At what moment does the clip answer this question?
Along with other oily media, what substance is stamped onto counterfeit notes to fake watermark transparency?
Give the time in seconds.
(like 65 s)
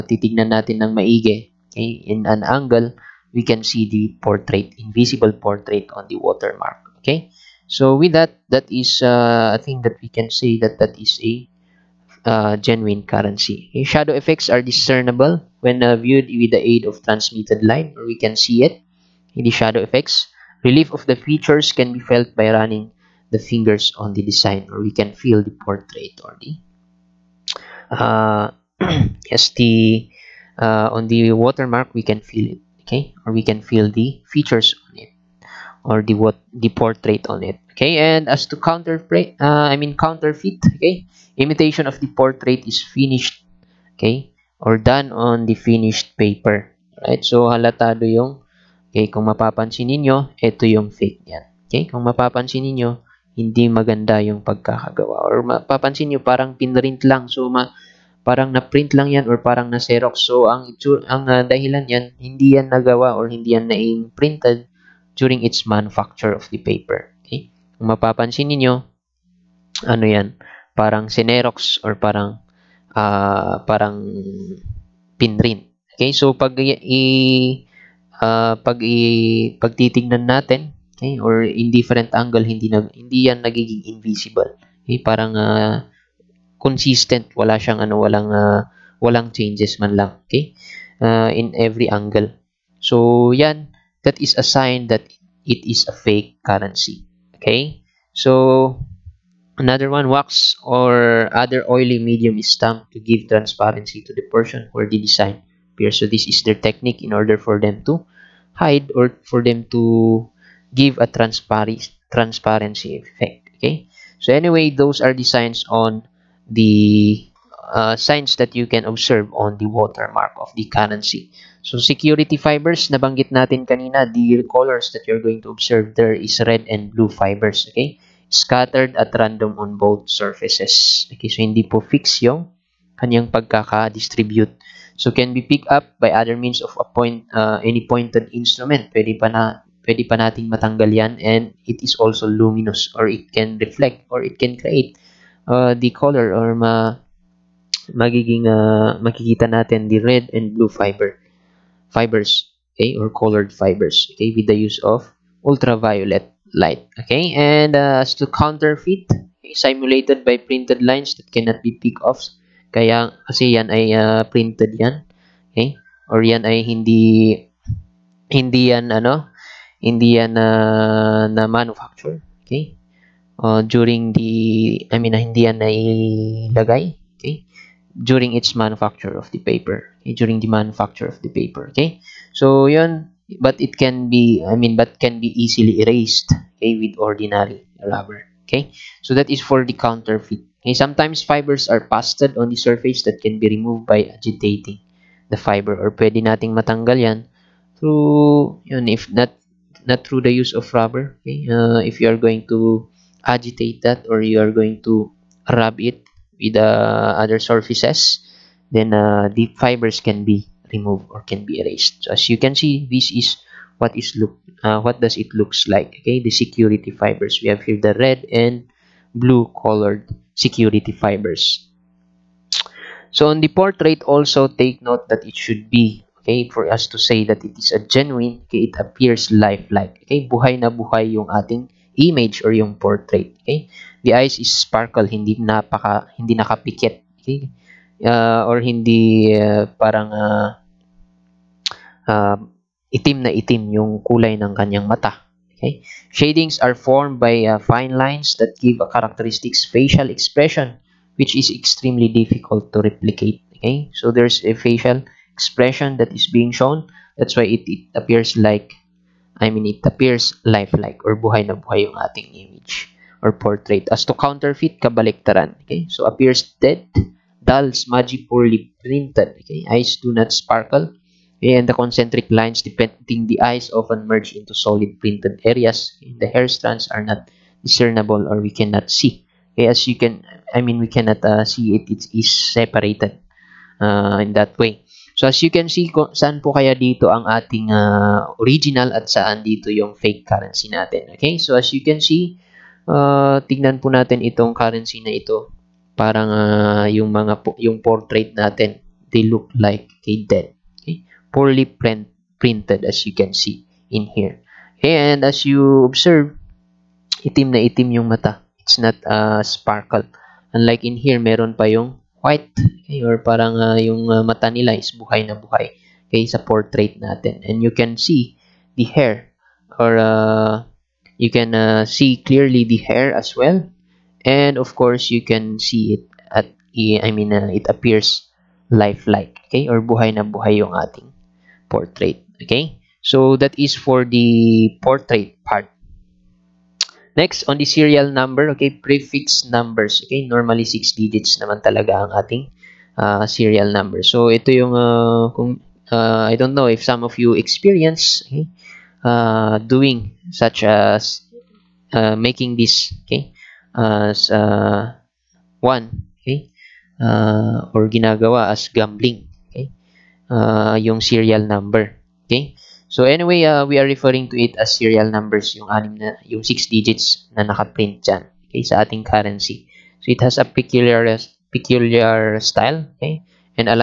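100 s.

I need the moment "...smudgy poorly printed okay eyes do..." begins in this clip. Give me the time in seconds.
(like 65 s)
267 s.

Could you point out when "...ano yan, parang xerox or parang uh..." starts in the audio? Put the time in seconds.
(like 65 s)
69 s.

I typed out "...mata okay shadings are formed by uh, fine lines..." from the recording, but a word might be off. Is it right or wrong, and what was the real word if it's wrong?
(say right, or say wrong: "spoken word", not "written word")
right.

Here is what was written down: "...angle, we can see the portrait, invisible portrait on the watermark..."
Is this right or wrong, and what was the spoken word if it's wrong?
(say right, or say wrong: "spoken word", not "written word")
right.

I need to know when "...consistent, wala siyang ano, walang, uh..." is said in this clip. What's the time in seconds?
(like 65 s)
86 s.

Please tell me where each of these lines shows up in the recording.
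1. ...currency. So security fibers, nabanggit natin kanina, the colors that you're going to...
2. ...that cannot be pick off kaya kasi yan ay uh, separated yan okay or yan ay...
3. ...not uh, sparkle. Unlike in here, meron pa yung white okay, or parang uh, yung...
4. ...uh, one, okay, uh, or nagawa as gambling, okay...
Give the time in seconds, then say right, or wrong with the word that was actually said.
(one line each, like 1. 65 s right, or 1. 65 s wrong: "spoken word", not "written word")
1. 120 s right
2. 161 s wrong: "printed", not "separated"
3. 308 s right
4. 354 s wrong: "ginagawa", not "nagawa".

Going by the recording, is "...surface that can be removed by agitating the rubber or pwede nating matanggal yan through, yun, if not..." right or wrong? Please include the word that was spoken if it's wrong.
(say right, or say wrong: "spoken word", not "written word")
wrong: "fiber", not "rubber".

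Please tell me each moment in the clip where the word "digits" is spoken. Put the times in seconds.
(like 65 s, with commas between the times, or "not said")
340 s, 366 s.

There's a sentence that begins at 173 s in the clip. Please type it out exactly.
Uh, during the, I mean, uh, hindi yan nailagay, okay?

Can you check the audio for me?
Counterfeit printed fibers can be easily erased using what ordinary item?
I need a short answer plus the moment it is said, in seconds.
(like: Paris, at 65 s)
ordinary rubber, at 186 s.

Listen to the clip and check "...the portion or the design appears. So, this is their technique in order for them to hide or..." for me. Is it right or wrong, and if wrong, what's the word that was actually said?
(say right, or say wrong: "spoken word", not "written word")
right.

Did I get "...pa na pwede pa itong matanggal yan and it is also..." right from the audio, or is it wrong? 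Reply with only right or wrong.
wrong.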